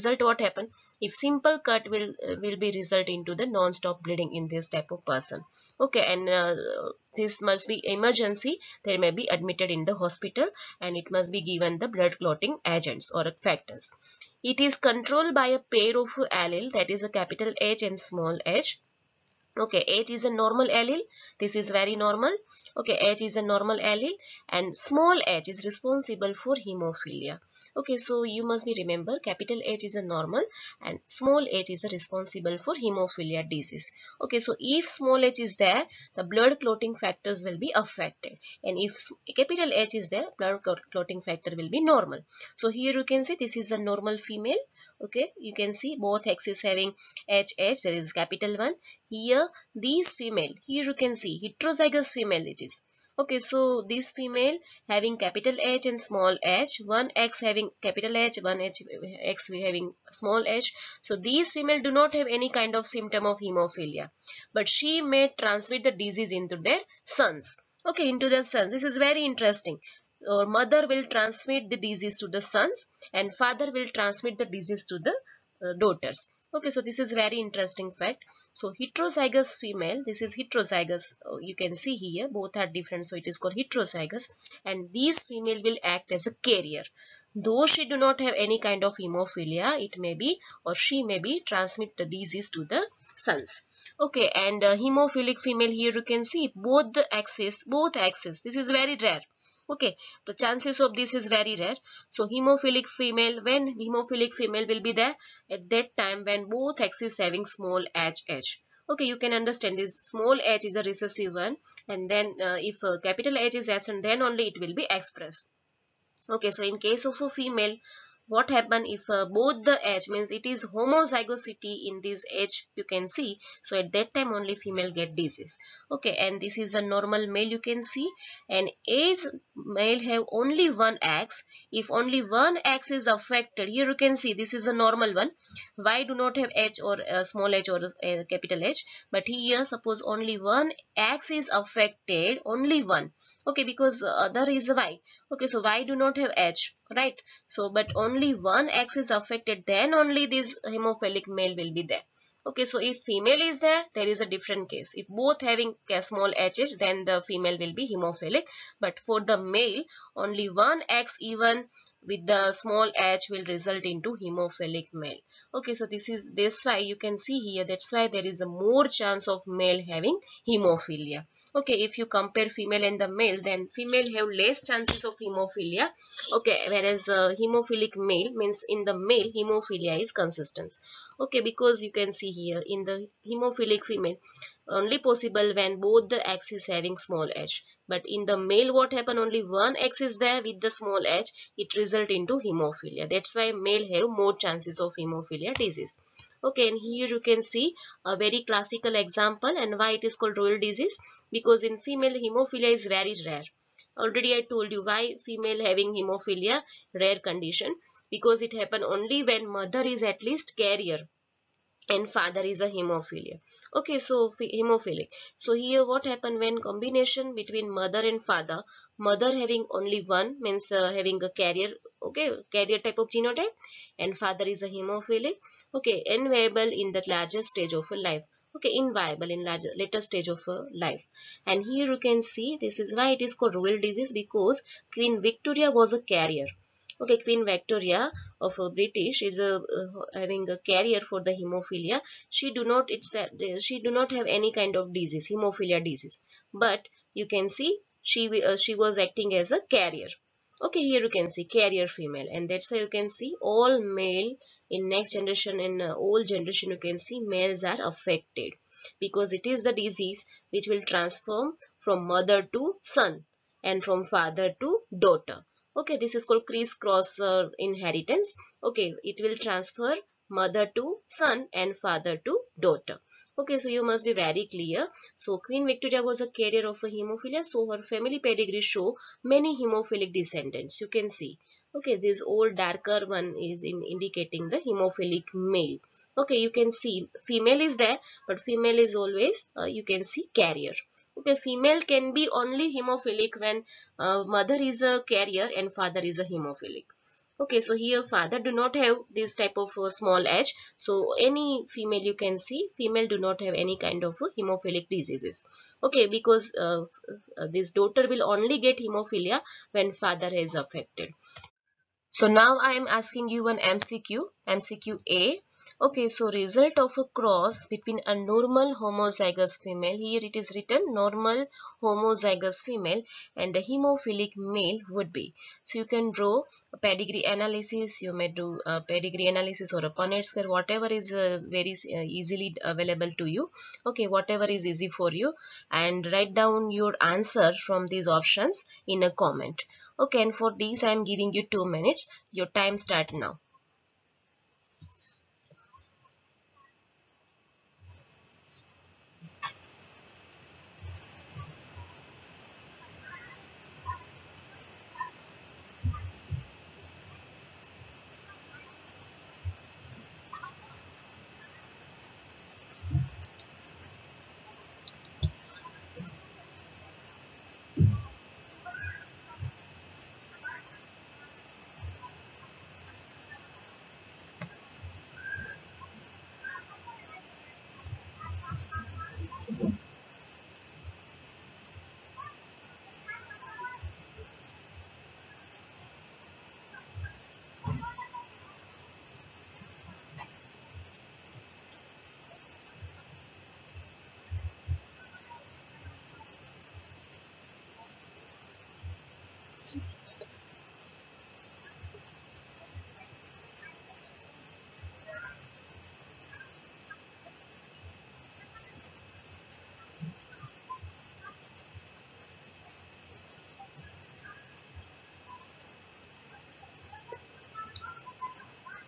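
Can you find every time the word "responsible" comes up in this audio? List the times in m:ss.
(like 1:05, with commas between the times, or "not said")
0:25, 0:31.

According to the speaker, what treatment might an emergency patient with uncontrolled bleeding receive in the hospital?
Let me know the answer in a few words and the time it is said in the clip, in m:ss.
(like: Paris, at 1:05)
blood clotting agents, at 0:11.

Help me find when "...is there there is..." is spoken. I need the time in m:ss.
2:33.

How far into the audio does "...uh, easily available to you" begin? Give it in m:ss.
5:31.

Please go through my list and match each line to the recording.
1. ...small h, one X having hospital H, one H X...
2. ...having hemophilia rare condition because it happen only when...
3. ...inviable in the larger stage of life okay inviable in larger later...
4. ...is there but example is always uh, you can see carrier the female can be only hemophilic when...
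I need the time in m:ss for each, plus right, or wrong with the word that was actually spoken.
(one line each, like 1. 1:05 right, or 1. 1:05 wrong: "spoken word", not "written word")
1. 0:55 wrong: "capital", not "hospital"
2. 3:25 right
3. 3:46 right
4. 4:47 wrong: "female", not "example".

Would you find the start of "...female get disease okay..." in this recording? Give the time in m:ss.
2:04.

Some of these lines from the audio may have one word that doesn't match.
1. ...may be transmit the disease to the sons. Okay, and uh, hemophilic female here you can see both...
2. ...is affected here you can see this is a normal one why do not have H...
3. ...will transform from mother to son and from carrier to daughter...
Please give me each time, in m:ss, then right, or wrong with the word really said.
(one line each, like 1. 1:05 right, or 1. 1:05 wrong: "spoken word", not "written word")
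1. 1:31 right
2. 2:12 right
3. 4:20 wrong: "father", not "carrier".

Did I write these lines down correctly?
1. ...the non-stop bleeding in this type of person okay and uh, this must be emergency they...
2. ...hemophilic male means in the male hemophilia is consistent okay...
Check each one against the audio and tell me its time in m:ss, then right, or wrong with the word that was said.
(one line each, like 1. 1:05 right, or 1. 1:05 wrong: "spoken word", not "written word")
1. 0:03 right
2. 2:57 right.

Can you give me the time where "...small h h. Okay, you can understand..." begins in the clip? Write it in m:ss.
1:47.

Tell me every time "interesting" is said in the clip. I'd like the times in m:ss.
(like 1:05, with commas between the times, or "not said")
1:09, 1:17.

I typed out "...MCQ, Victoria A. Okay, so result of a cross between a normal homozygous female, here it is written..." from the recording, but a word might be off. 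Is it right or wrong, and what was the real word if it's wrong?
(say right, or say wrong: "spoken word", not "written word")
wrong: "MCQ", not "Victoria".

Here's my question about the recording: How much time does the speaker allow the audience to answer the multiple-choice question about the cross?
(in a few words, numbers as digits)
2 minutes.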